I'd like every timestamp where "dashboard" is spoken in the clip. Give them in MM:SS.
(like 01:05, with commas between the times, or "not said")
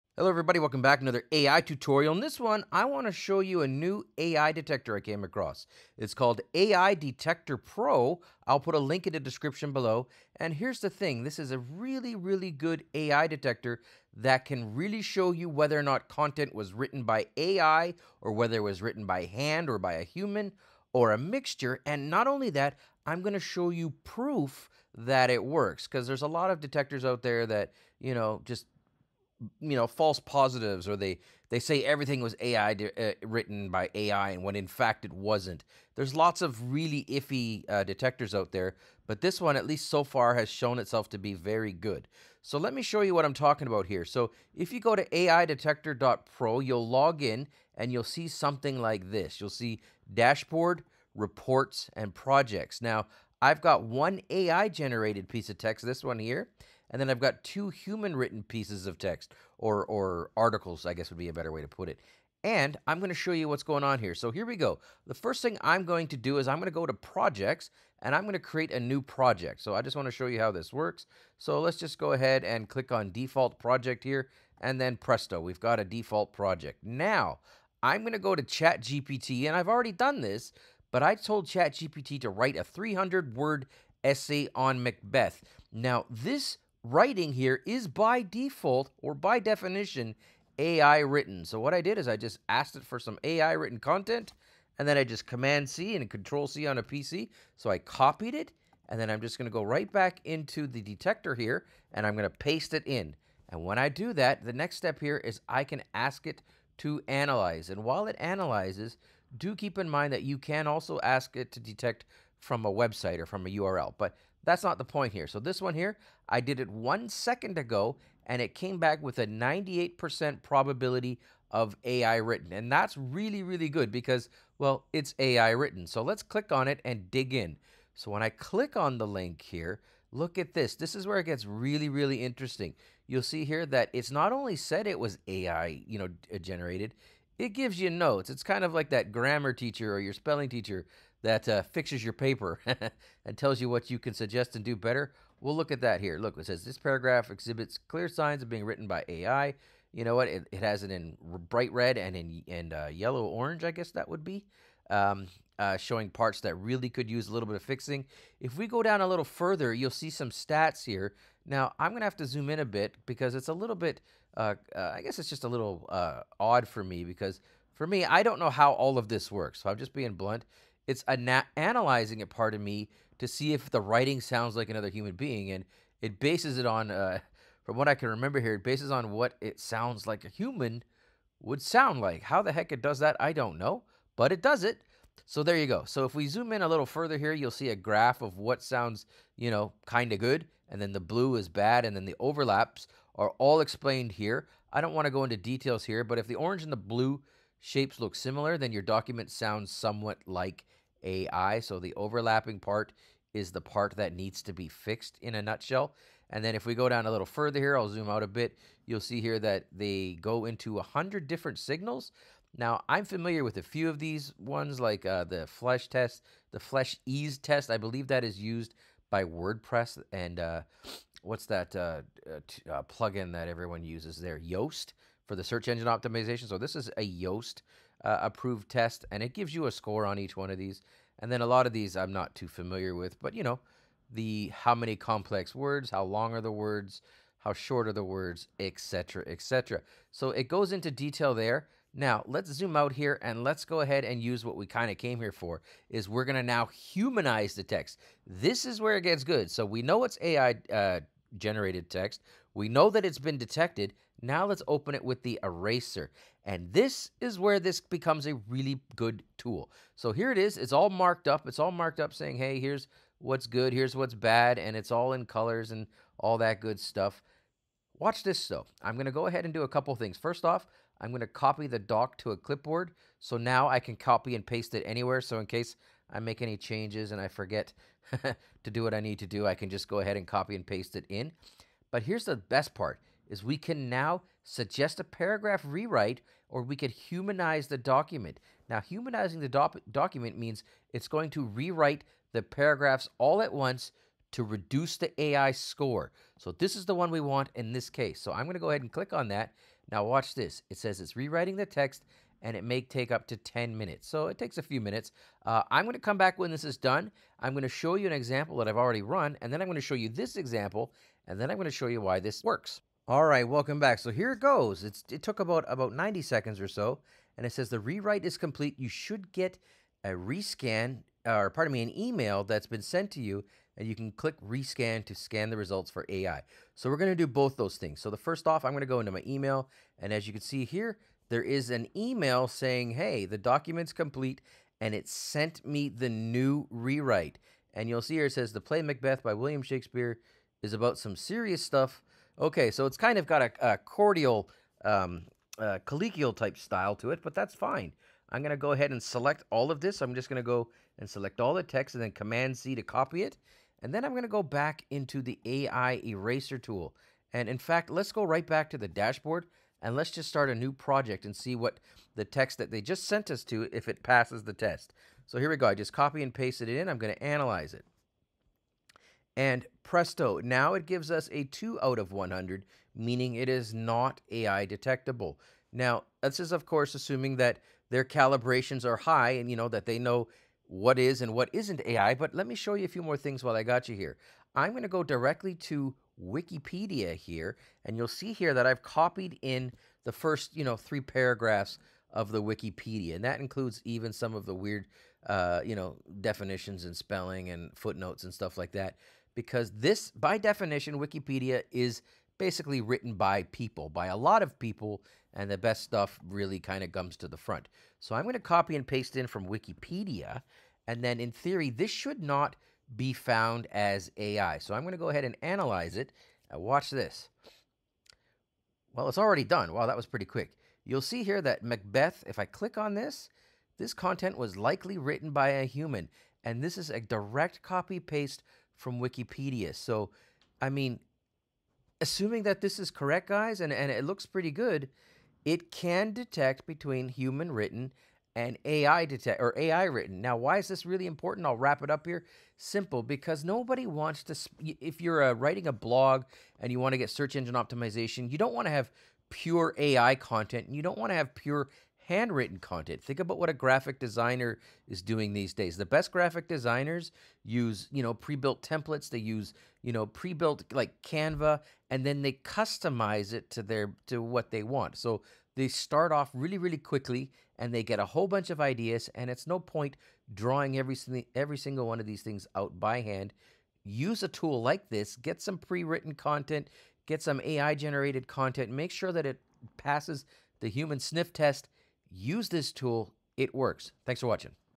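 00:50, 05:58.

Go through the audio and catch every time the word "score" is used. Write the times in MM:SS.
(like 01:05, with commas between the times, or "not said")
03:49, 04:55.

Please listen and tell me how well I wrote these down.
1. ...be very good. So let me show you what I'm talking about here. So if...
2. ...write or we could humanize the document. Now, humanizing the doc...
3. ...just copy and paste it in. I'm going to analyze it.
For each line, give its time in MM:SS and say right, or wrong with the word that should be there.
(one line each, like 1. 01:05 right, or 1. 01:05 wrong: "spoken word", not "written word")
1. 00:41 right
2. 04:45 wrong: "rewrite", not "write"
3. 06:05 right.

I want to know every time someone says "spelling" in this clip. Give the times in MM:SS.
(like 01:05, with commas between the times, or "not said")
02:20, 06:36.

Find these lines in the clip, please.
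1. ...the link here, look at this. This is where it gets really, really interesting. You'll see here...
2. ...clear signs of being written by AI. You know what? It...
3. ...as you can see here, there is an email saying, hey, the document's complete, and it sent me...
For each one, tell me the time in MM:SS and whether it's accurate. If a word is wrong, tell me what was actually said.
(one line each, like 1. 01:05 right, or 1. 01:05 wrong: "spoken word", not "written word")
1. 02:08 right
2. 02:27 right
3. 05:30 right.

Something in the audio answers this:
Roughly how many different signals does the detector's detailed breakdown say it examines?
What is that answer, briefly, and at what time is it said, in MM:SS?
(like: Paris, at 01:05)
100, at 03:30.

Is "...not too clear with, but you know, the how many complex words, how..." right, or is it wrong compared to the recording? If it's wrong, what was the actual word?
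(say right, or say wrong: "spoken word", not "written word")
wrong: "familiar", not "clear".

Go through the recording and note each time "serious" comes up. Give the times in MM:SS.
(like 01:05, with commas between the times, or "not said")
05:41.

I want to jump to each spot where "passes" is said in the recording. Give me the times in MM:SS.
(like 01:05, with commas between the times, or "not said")
06:04, 07:59.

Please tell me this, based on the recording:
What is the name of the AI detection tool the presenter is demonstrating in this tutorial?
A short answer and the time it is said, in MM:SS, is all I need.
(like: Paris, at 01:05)
AI Detector Pro, at 00:06.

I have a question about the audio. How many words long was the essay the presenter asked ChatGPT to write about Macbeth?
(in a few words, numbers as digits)
300.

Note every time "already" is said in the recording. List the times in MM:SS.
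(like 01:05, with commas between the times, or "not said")
01:19, 05:08, 06:59.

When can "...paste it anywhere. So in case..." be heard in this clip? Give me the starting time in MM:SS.
04:34.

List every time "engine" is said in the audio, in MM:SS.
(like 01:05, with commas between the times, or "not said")
03:45, 07:27.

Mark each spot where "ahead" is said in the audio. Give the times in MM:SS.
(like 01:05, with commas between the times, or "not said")
01:12, 04:03, 04:29, 04:39, 04:58, 05:48, 06:55.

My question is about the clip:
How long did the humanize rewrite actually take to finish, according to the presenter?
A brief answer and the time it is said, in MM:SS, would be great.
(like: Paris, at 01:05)
About 90 seconds, at 05:15.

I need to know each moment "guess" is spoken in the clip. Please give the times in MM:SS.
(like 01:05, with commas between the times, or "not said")
01:00, 02:33, 02:45.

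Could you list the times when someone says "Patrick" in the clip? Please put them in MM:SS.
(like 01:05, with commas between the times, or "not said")
not said.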